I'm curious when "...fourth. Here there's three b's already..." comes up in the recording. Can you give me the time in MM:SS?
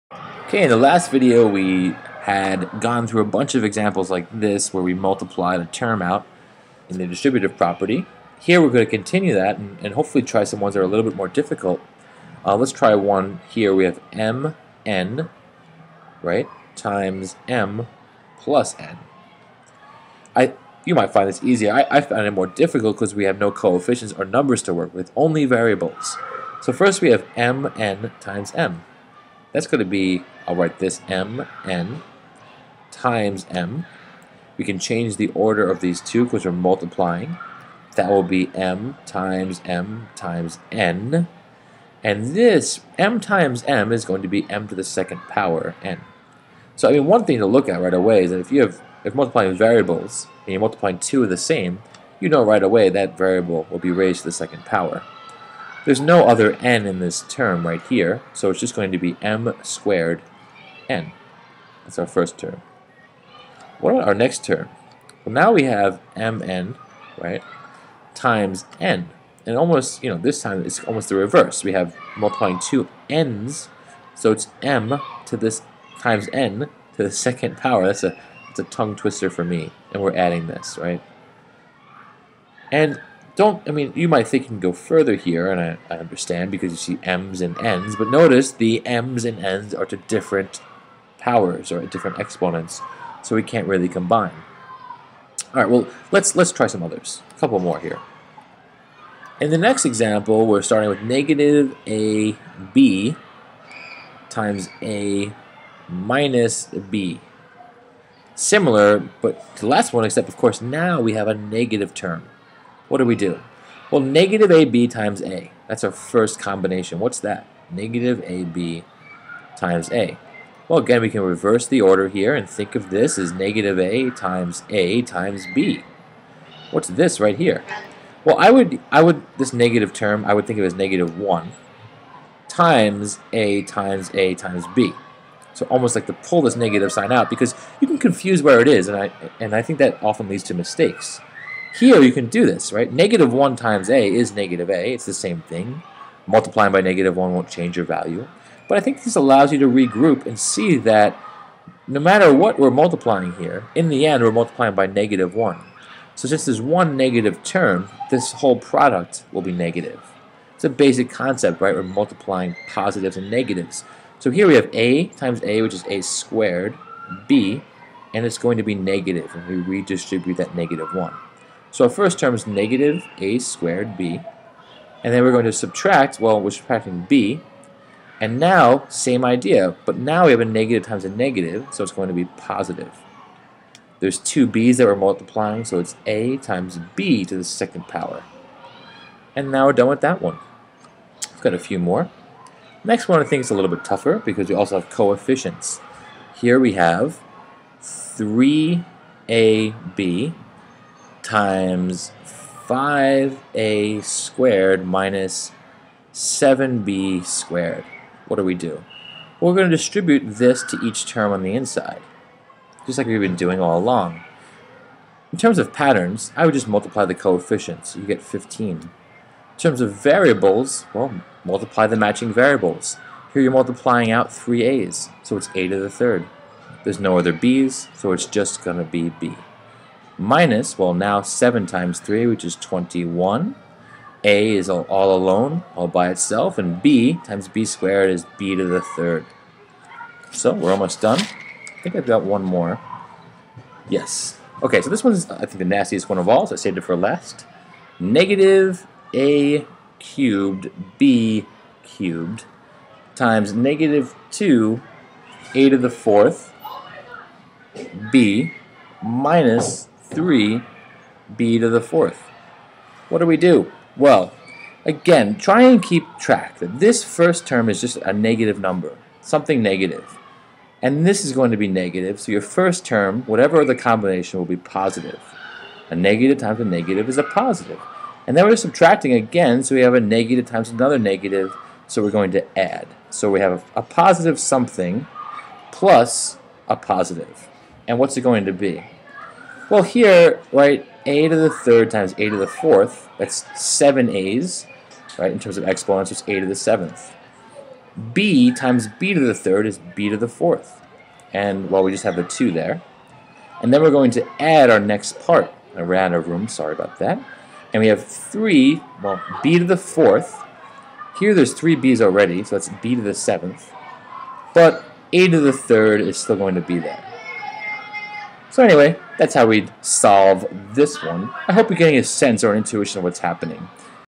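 05:09.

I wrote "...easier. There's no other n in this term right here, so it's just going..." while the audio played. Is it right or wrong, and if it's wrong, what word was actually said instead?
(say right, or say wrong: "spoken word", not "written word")
wrong: "power", not "easier".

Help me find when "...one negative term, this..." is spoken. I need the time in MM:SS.
02:36.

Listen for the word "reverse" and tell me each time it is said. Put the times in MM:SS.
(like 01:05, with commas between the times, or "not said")
01:11, 02:01.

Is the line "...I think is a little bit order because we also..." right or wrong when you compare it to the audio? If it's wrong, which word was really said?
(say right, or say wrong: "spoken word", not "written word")
wrong: "tougher", not "order".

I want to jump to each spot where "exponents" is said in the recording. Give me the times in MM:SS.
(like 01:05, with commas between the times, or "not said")
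01:32, 04:55.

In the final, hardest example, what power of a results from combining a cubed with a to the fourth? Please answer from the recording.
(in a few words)
a to the seventh.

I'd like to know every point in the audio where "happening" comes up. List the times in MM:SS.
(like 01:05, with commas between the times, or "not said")
05:23.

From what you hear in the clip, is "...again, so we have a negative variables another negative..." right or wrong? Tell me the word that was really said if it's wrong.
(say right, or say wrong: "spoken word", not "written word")
wrong: "times", not "variables".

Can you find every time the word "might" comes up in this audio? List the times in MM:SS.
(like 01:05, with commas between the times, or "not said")
00:20, 01:24.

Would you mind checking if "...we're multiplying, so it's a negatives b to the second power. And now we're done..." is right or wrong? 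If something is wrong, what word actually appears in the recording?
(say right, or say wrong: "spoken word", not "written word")
wrong: "times", not "negatives".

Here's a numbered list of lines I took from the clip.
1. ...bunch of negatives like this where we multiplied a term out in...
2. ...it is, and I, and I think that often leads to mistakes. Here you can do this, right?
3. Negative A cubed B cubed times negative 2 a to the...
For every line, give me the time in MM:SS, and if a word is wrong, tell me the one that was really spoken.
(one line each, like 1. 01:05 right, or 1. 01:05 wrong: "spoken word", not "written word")
1. 00:03 wrong: "examples", not "negatives"
2. 02:18 right
3. 04:07 right.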